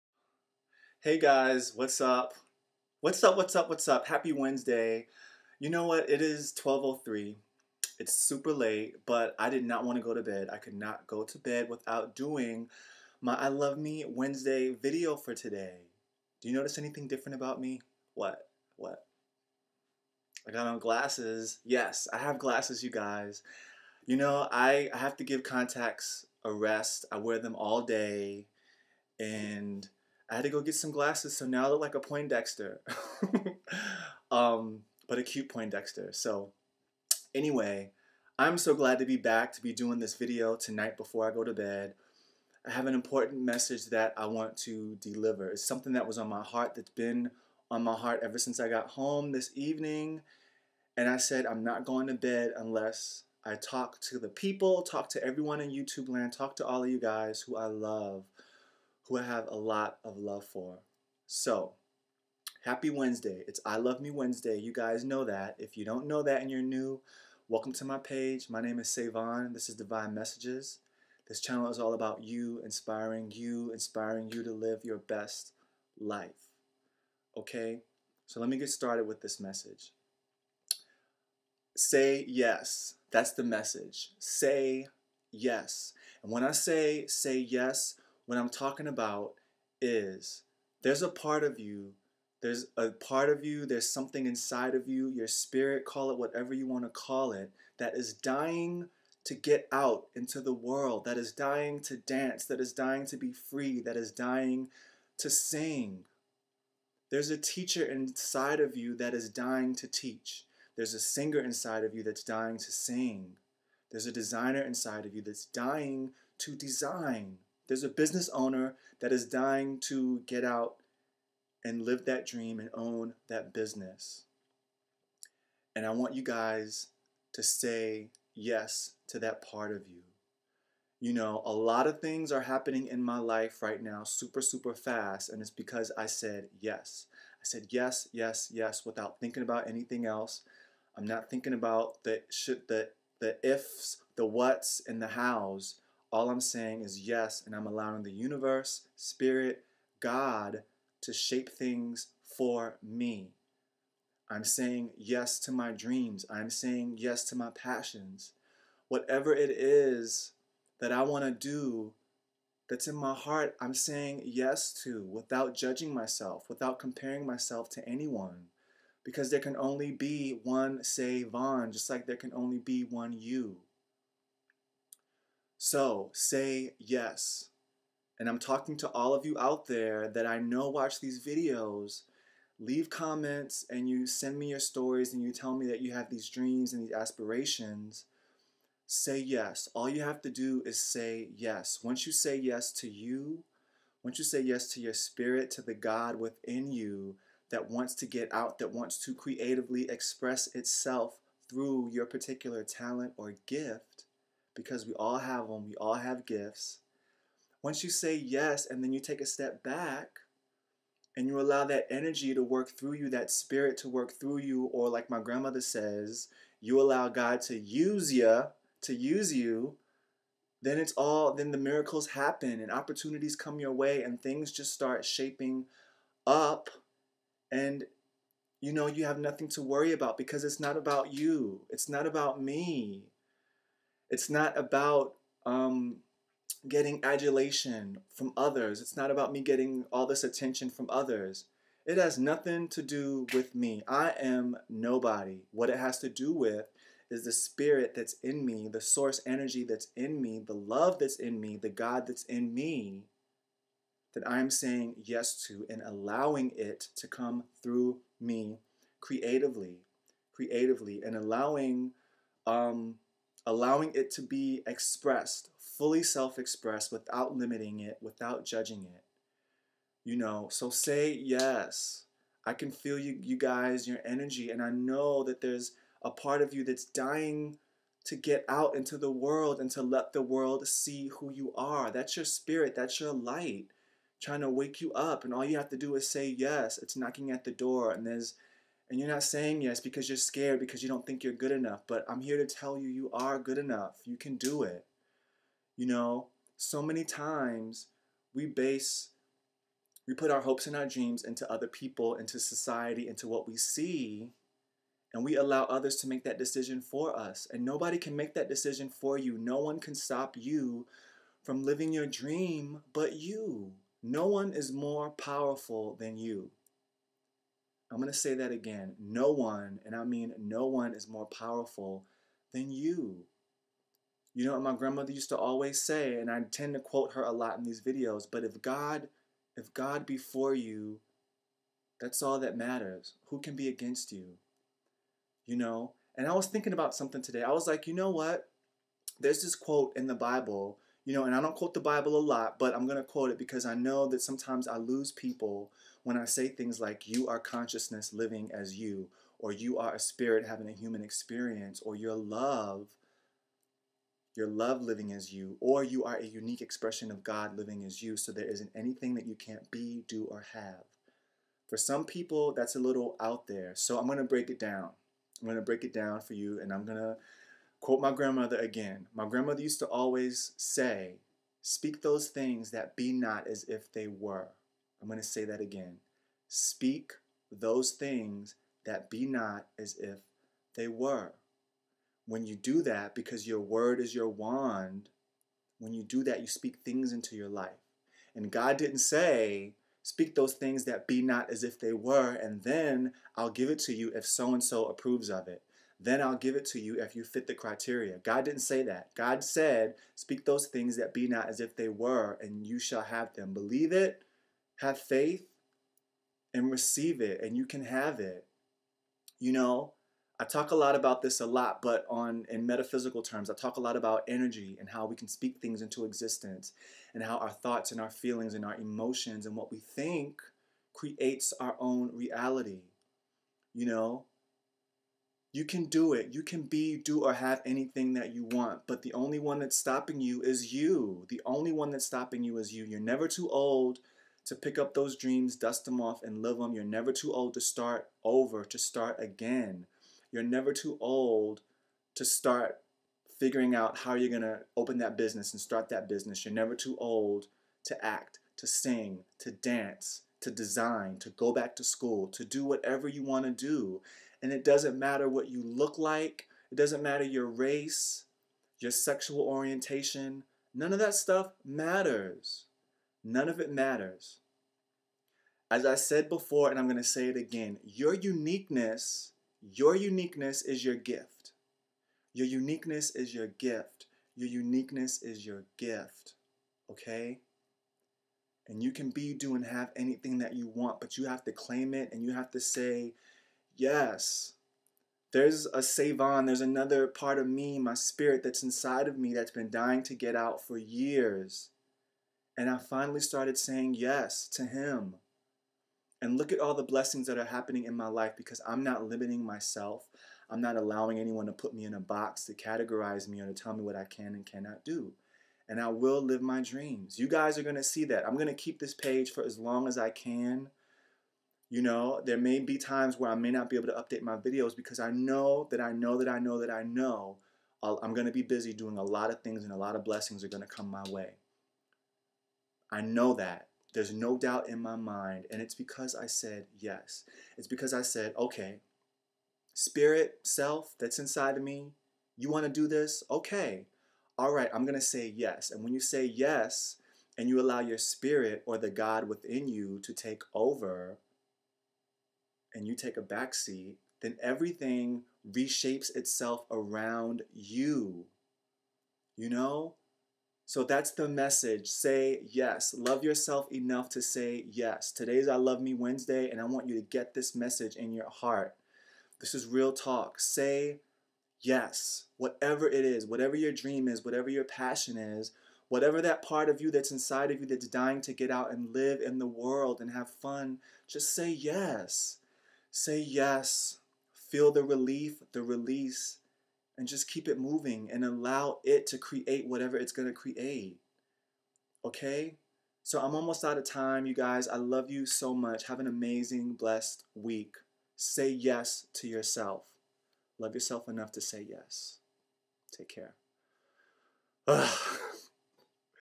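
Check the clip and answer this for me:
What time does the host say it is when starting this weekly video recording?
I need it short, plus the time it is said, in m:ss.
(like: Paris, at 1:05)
12:03, at 0:06.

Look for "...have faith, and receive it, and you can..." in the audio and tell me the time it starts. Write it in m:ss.
6:44.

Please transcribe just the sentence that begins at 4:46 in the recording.
It's knocking at the door, and there's and you're not saying yes because you're scared because you don't think you're good enough.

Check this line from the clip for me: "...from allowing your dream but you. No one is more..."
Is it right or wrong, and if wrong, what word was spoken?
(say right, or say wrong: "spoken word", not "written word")
wrong: "living", not "allowing".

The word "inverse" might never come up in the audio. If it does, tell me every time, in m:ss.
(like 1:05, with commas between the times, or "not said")
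not said.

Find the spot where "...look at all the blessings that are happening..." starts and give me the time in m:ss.
8:16.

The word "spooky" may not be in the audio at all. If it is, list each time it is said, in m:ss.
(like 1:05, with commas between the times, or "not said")
not said.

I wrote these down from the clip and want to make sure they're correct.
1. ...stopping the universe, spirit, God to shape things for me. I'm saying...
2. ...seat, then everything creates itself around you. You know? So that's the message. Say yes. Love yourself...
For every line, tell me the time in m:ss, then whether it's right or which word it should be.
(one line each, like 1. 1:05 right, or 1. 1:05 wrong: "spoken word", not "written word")
1. 2:27 wrong: "allowing", not "stopping"
2. 9:03 wrong: "reshapes", not "creates".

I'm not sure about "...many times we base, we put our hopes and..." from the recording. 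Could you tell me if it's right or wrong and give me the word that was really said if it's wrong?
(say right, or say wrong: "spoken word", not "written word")
right.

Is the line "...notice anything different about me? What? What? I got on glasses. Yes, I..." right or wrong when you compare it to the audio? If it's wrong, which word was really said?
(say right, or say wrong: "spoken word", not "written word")
right.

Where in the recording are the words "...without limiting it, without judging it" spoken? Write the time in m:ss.
4:26.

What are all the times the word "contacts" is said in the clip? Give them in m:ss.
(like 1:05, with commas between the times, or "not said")
0:25.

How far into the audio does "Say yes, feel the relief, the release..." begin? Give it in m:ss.
9:32.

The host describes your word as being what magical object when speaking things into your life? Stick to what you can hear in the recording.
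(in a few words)
Your wand.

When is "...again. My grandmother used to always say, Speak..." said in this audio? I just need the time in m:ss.
6:08.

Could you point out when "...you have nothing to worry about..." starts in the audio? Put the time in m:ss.
3:48.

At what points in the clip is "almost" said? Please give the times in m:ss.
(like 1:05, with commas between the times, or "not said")
9:43.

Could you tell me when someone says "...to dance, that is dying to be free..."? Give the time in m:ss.
1:41.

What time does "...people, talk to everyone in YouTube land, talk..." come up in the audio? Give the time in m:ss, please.
0:54.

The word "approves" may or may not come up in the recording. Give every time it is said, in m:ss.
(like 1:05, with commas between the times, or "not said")
6:34.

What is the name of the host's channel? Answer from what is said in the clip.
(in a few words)
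Divine Messages.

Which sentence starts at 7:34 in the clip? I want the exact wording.
And it doesn't matter what you look like, it doesn't matter your race, your sexual orientation.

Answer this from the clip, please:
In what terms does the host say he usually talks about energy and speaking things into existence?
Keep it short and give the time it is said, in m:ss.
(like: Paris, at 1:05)
Metaphysical, at 6:52.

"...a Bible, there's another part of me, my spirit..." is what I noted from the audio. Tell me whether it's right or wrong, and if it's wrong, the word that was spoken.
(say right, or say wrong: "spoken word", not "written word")
wrong: "Savonn", not "Bible".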